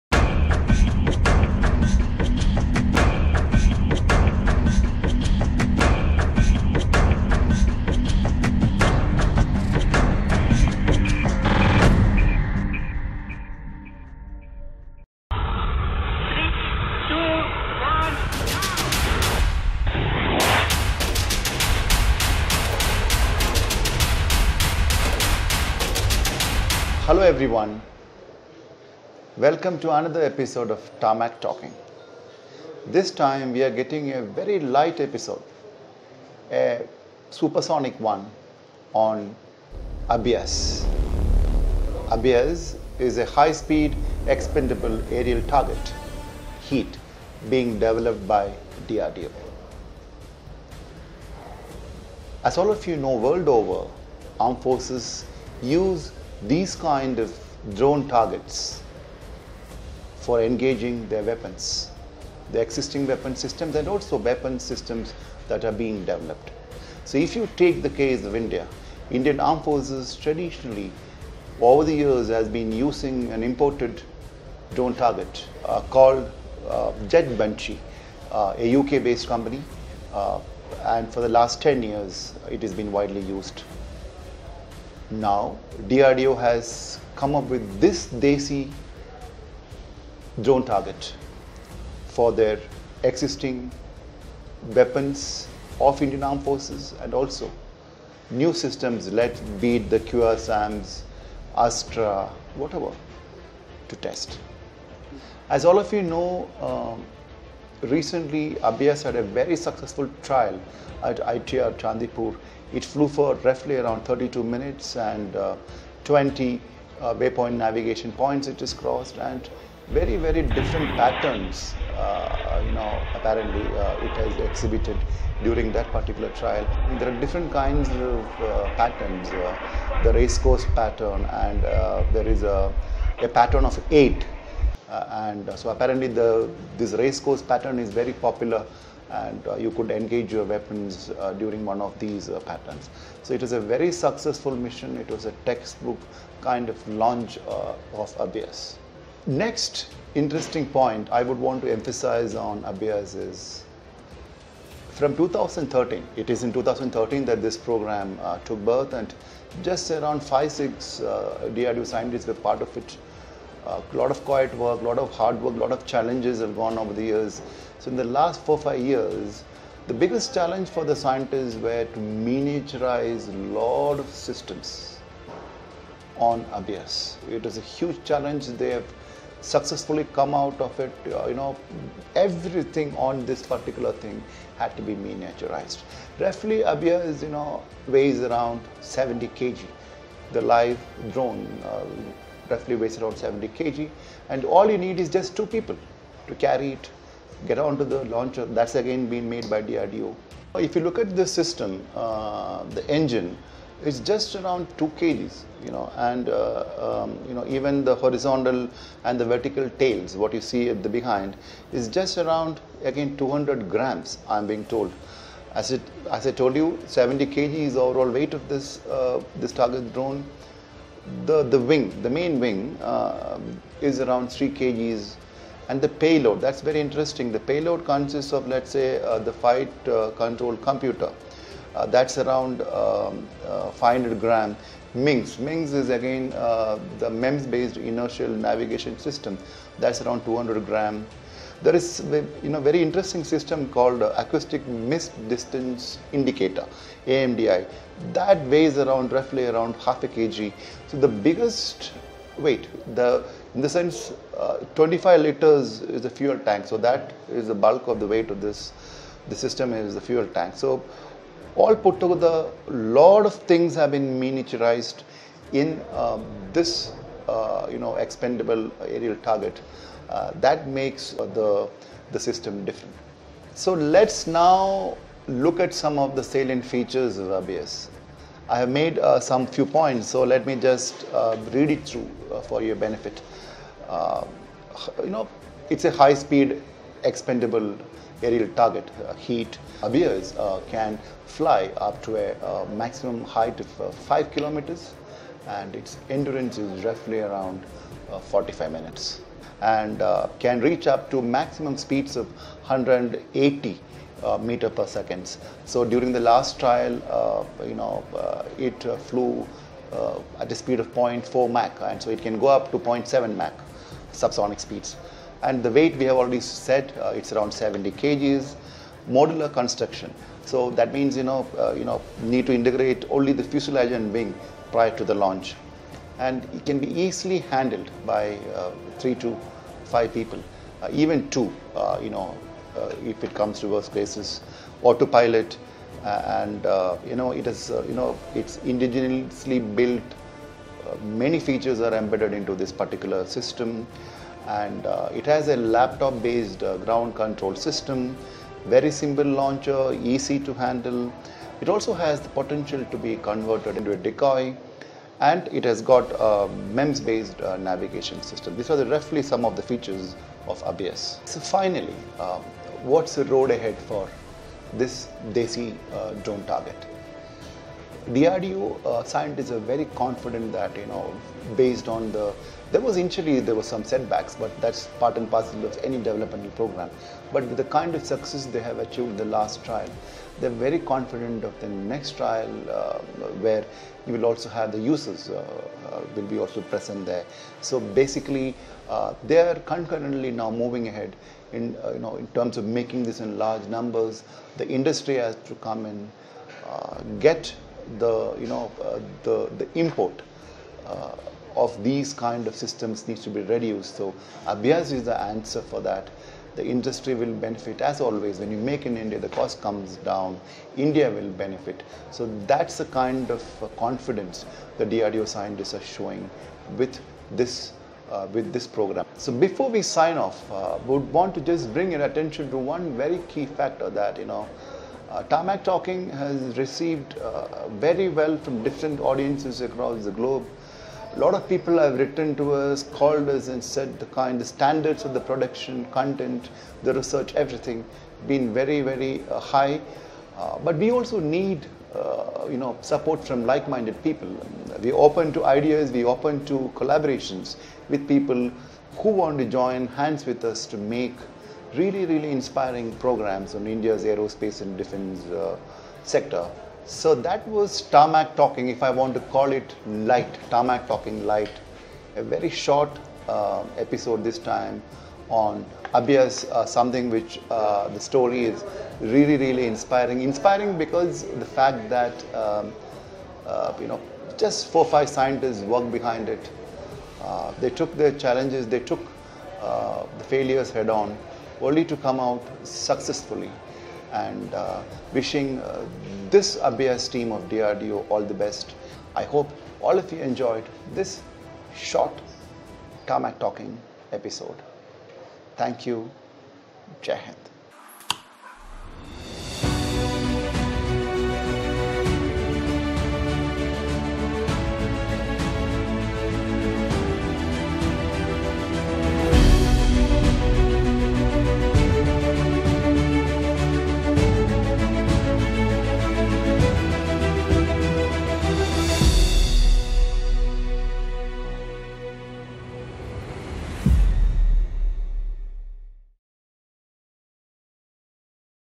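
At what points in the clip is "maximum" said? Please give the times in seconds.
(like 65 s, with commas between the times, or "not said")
292 s, 301 s.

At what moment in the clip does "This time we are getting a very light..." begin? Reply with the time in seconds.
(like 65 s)
32 s.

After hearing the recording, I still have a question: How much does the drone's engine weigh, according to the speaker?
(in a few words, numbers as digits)
2 kg.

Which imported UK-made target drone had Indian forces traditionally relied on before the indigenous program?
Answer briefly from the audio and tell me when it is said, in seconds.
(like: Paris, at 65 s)
Jet Banshee, at 77 s.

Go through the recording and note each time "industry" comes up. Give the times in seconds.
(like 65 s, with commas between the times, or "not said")
394 s, 406 s.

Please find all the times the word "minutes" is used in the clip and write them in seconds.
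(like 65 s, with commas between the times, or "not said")
114 s, 298 s.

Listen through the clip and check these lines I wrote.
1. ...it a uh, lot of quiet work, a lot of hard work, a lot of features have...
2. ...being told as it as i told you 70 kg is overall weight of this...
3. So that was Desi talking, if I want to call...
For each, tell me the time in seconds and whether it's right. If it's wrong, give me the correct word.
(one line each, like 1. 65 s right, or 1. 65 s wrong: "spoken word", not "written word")
1. 162 s wrong: "challenges", not "features"
2. 214 s right
3. 456 s wrong: "Tarmak", not "Desi".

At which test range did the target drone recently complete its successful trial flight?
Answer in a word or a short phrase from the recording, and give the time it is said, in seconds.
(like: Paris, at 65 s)
ITR Chandipur, at 111 s.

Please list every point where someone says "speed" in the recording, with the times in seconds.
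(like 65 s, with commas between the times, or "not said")
43 s, 285 s, 301 s, 310 s, 314 s.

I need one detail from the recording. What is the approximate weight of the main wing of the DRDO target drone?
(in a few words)
3 kg.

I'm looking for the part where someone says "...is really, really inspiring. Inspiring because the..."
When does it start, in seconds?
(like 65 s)
468 s.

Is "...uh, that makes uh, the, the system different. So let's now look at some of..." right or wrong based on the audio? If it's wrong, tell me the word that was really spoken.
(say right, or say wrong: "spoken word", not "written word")
right.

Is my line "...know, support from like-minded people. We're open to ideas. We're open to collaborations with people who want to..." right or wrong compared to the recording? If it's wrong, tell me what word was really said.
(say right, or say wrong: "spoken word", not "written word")
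right.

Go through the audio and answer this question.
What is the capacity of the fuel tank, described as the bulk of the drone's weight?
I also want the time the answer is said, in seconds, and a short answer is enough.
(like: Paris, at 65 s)
25 liters, at 254 s.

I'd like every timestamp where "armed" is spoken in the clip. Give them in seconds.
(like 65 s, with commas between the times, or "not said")
54 s, 69 s, 96 s.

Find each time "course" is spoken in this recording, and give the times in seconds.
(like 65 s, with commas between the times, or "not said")
130 s, 137 s.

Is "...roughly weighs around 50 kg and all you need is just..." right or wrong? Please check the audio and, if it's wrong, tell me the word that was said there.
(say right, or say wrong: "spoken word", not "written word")
wrong: "70", not "50".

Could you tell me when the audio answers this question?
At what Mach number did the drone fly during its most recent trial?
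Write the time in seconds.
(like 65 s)
310 s.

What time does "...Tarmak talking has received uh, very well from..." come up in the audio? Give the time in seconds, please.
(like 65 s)
425 s.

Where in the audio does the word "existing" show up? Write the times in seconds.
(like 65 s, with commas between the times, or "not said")
62 s, 93 s.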